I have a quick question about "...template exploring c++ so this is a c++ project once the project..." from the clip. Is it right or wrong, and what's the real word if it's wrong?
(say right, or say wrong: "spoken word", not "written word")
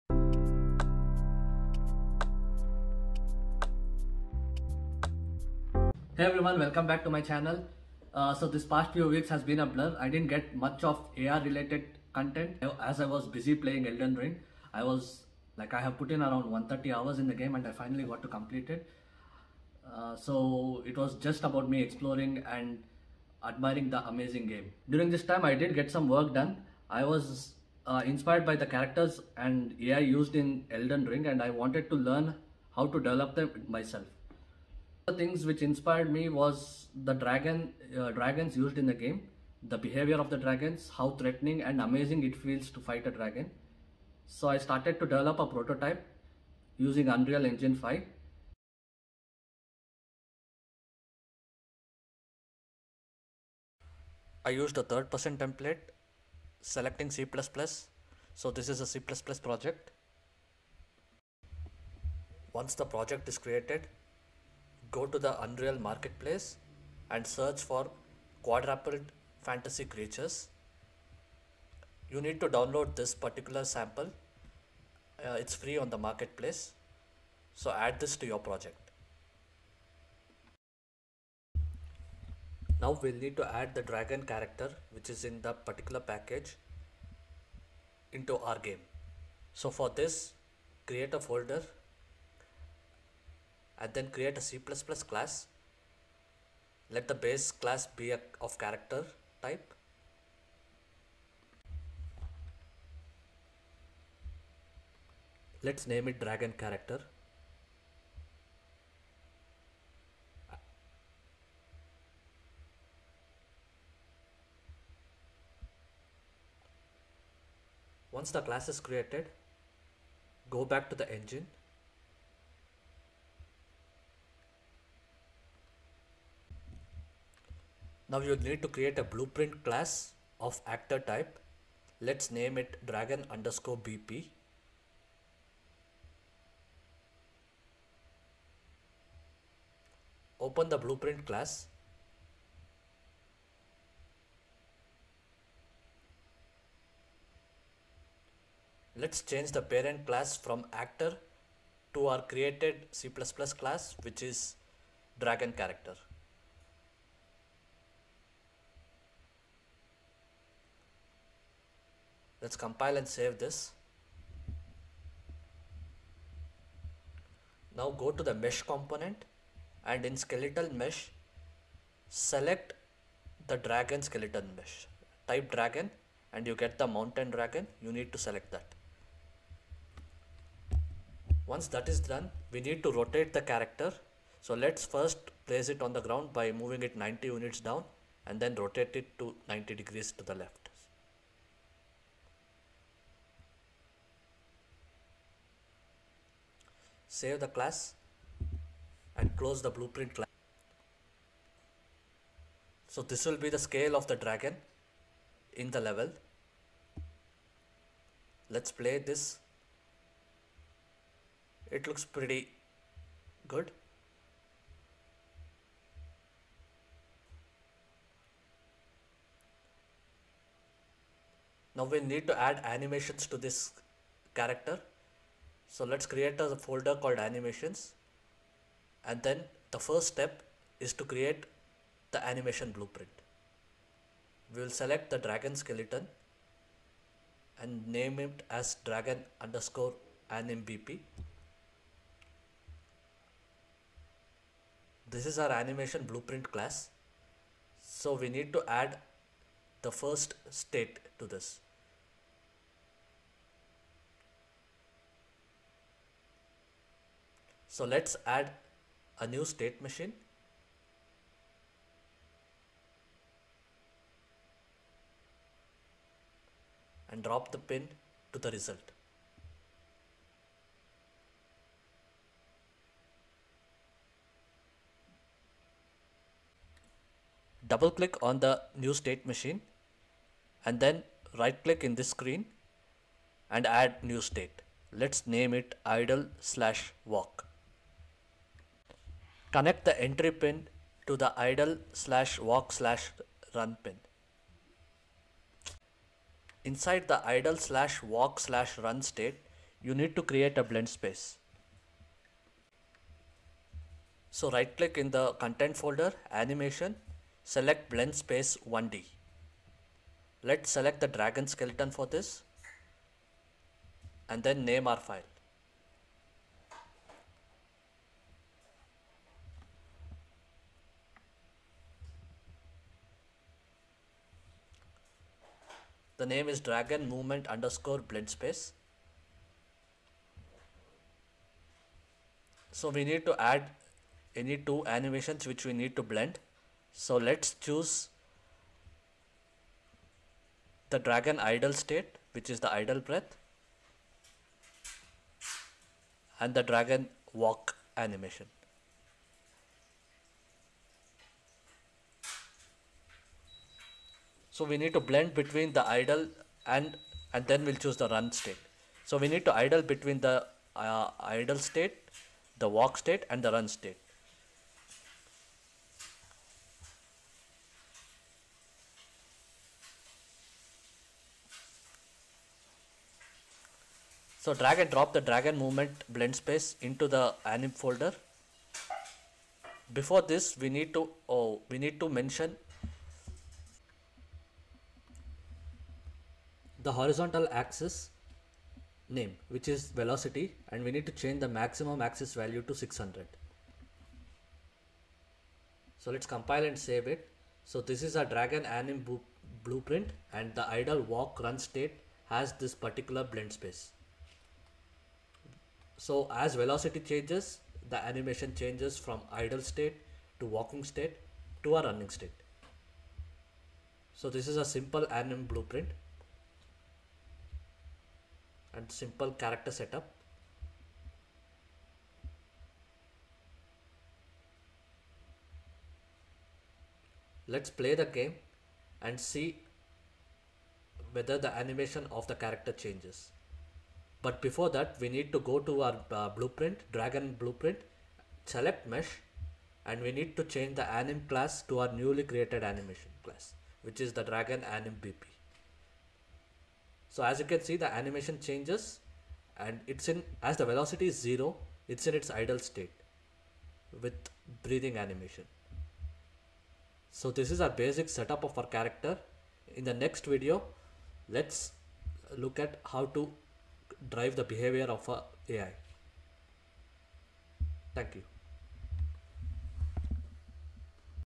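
wrong: "selecting", not "exploring".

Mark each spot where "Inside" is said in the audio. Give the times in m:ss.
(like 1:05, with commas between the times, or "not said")
4:56.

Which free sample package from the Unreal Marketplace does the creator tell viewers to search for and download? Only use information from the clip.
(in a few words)
Quadruped Fantasy Creatures.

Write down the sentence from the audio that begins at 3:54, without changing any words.
We will select the dragon skeleton and name it as dragon underscore animbp.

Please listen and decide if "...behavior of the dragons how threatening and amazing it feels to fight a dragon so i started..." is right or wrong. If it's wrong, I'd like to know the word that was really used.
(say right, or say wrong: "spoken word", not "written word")
right.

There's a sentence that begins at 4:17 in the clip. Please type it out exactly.
So let's add a new state machine.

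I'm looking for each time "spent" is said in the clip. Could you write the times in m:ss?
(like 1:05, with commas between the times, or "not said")
not said.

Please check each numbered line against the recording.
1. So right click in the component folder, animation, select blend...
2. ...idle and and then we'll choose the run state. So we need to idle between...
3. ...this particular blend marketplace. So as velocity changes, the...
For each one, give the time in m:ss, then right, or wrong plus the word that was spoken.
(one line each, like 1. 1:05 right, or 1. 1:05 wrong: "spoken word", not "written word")
1. 5:04 wrong: "content", not "component"
2. 5:55 right
3. 6:42 wrong: "space", not "marketplace".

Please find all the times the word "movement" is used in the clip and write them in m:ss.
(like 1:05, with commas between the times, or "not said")
5:27, 6:15.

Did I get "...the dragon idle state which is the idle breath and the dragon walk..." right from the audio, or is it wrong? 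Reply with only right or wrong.
right.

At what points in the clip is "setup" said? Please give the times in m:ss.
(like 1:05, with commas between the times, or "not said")
6:59, 7:38.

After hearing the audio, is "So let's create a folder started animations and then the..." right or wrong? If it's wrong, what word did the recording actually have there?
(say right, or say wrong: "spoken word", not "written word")
wrong: "called", not "started".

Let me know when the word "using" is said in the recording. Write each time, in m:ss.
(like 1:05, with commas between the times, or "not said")
0:46.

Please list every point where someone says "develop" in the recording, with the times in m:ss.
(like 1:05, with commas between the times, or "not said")
0:32, 0:45.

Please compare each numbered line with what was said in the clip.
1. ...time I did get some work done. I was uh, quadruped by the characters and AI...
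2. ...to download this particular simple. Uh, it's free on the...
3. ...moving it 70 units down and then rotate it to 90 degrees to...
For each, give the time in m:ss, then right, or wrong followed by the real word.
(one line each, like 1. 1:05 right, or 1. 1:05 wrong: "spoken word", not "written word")
1. 0:25 wrong: "inspired", not "quadruped"
2. 1:12 wrong: "sample", not "simple"
3. 3:06 wrong: "90", not "70".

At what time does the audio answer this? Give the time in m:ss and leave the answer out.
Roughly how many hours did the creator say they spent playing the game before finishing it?
0:16.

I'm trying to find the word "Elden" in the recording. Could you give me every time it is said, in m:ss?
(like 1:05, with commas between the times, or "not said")
0:13, 0:30.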